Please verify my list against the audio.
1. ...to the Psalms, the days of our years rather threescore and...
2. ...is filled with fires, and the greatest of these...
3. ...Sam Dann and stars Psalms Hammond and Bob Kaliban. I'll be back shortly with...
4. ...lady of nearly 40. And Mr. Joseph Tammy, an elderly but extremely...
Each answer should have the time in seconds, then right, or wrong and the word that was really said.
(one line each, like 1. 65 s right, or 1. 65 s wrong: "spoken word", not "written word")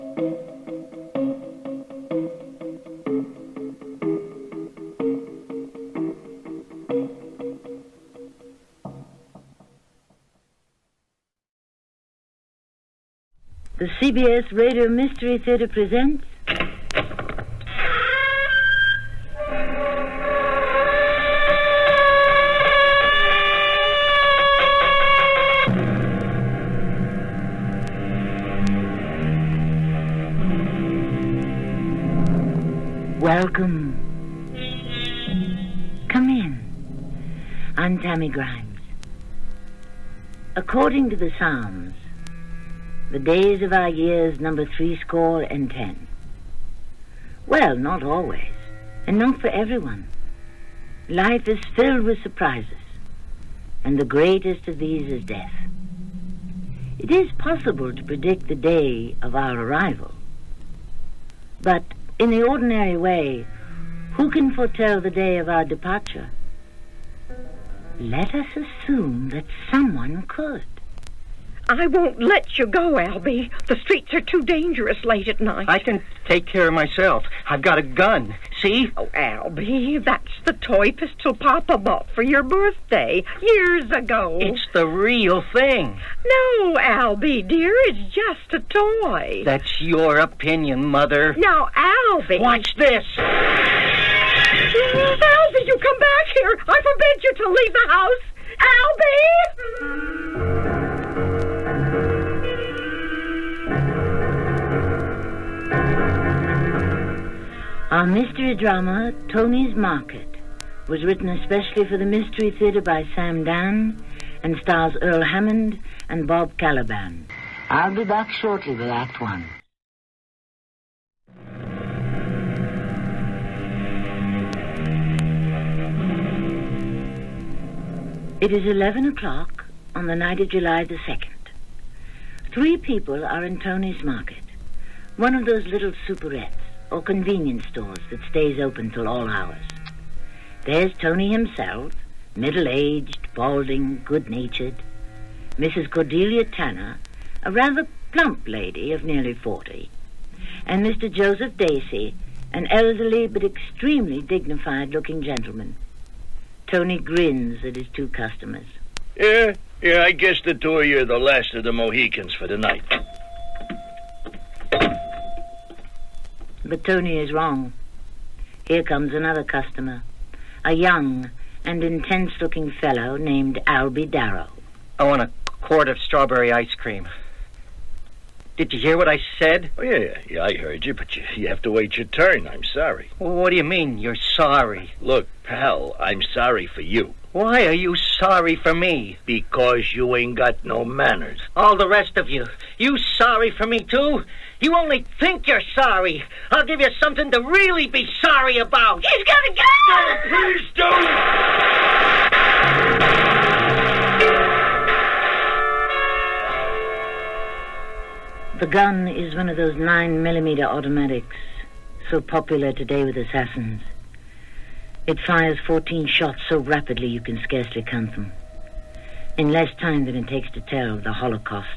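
1. 41 s wrong: "number", not "rather"
2. 51 s wrong: "surprises", not "fires"
3. 113 s wrong: "Earl", not "Psalms"
4. 148 s wrong: "Dacey", not "Tammy".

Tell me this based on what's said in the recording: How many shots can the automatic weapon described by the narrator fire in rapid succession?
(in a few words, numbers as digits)
14.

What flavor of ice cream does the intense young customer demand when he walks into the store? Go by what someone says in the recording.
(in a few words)
Strawberry.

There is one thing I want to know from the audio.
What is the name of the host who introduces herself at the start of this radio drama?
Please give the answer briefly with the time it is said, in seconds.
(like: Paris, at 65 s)
Tammy Grimes, at 37 s.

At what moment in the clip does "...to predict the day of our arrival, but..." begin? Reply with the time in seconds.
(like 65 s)
57 s.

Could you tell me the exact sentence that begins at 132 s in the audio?
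Three people are in Tony's Market, one of those little superettes or convenience stores that stays open till all hours.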